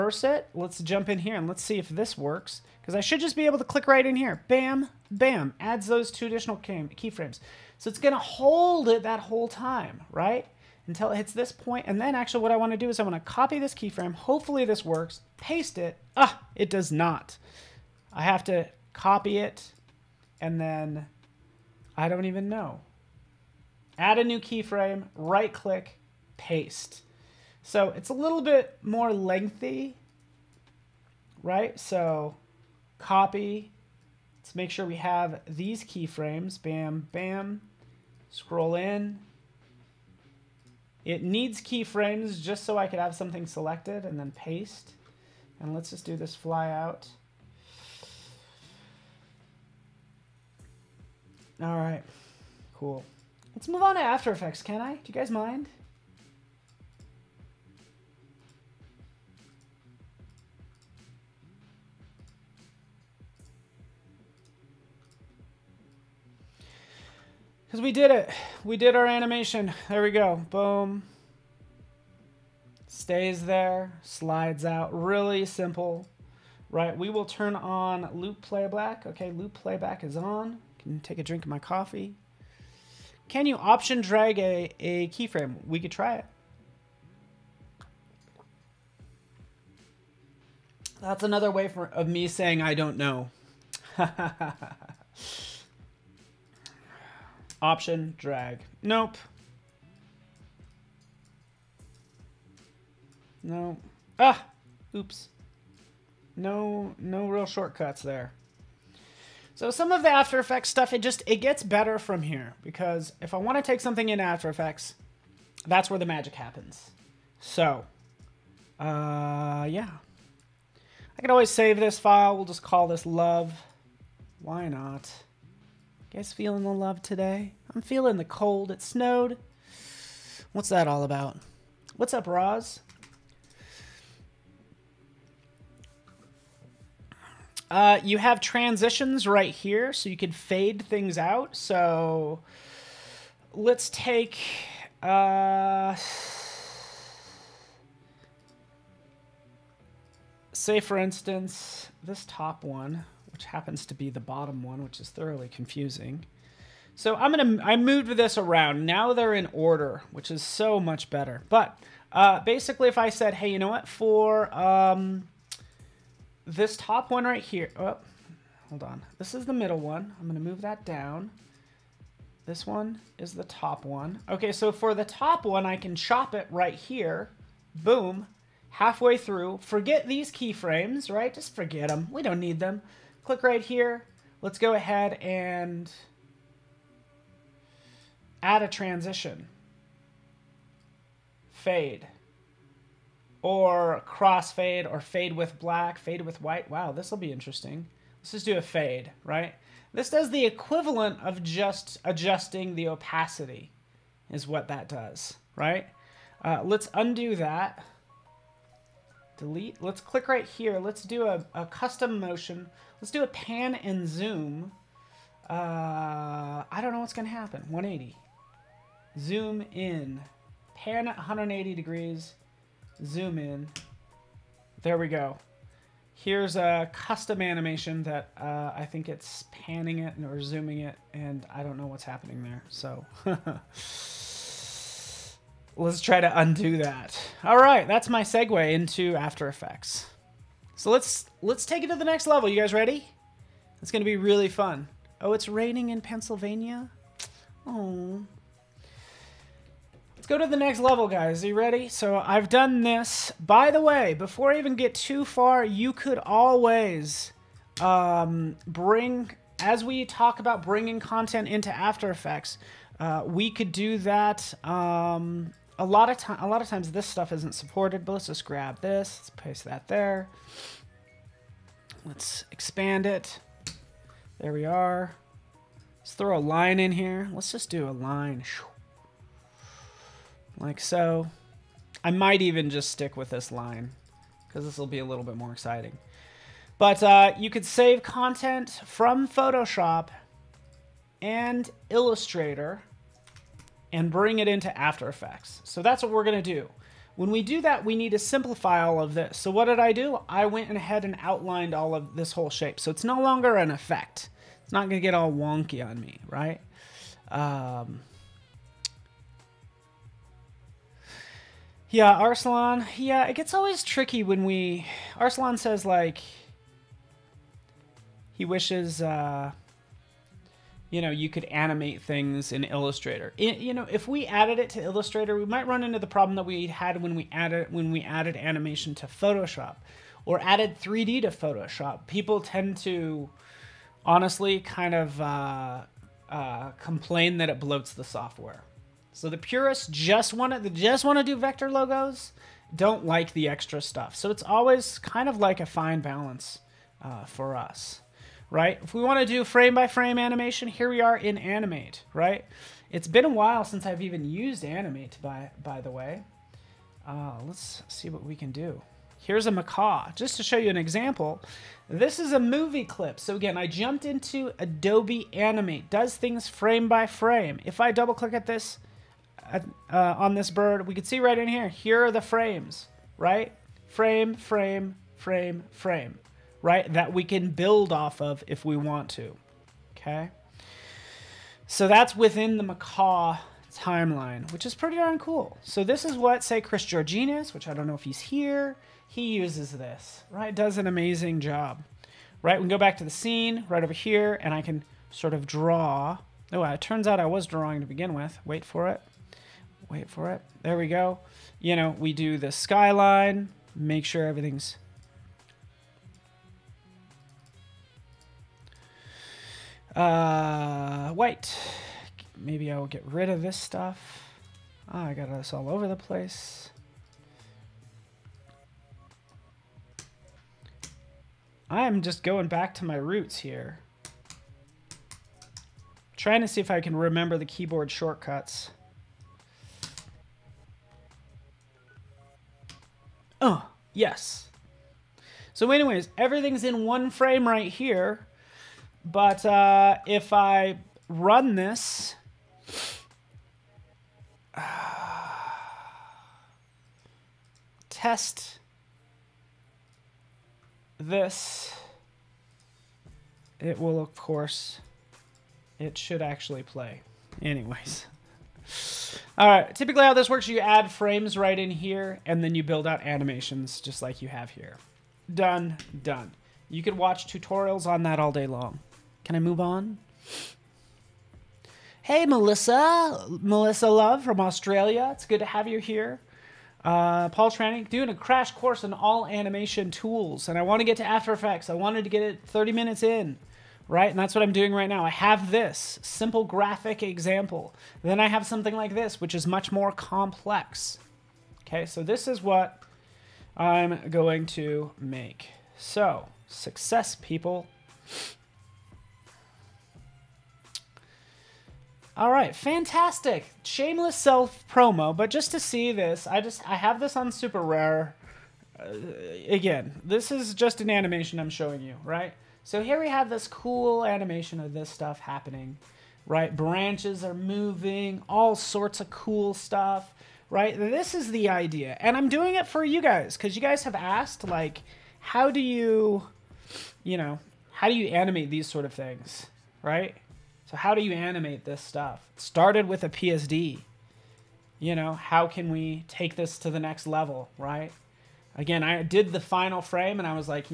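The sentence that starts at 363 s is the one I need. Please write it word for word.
So again, I jumped into Adobe Animate.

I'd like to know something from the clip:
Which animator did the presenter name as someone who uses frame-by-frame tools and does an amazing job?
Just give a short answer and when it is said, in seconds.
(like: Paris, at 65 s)
Chris Georgenes, at 386 s.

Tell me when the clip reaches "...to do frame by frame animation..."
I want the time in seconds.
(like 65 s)
349 s.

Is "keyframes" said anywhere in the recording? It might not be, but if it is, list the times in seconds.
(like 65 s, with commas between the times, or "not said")
6 s, 13 s, 24 s, 35 s, 41 s, 85 s, 180 s.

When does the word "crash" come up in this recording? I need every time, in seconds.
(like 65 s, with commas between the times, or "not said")
478 s.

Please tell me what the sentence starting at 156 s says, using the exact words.
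So I'm gonna I moved this around.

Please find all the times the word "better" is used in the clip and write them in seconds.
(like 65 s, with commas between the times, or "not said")
111 s, 161 s.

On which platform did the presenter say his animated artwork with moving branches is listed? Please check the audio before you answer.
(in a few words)
SuperRare.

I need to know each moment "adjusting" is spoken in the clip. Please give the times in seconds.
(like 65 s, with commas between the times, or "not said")
202 s.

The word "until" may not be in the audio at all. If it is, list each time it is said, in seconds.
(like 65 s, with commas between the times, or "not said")
10 s.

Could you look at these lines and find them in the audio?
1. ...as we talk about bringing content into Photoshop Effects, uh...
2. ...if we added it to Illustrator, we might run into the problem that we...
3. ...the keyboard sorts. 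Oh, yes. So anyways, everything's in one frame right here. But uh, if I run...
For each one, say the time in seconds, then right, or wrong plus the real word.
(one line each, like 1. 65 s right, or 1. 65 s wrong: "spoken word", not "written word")
1. 259 s wrong: "After", not "Photoshop"
2. 323 s right
3. 427 s wrong: "shortcuts", not "sorts".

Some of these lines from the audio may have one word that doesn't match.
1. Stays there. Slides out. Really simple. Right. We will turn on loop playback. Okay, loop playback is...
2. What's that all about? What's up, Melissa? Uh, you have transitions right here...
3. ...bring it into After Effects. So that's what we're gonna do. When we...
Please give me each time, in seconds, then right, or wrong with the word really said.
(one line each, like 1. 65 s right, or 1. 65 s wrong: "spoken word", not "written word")
1. 72 s right
2. 130 s wrong: "Roz", not "Melissa"
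3. 294 s right.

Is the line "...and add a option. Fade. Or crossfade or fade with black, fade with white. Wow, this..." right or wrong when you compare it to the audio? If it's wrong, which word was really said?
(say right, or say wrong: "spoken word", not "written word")
wrong: "transition", not "option".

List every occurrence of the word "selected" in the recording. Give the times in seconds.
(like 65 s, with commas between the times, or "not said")
43 s.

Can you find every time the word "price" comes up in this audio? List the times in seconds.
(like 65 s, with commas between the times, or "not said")
not said.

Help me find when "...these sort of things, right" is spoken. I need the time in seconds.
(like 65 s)
528 s.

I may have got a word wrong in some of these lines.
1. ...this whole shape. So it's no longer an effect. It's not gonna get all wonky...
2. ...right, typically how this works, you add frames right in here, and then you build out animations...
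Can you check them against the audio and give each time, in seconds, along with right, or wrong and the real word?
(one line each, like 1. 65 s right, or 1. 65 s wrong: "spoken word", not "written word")
1. 302 s right
2. 459 s right.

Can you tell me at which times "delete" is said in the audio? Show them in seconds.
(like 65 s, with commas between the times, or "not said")
209 s.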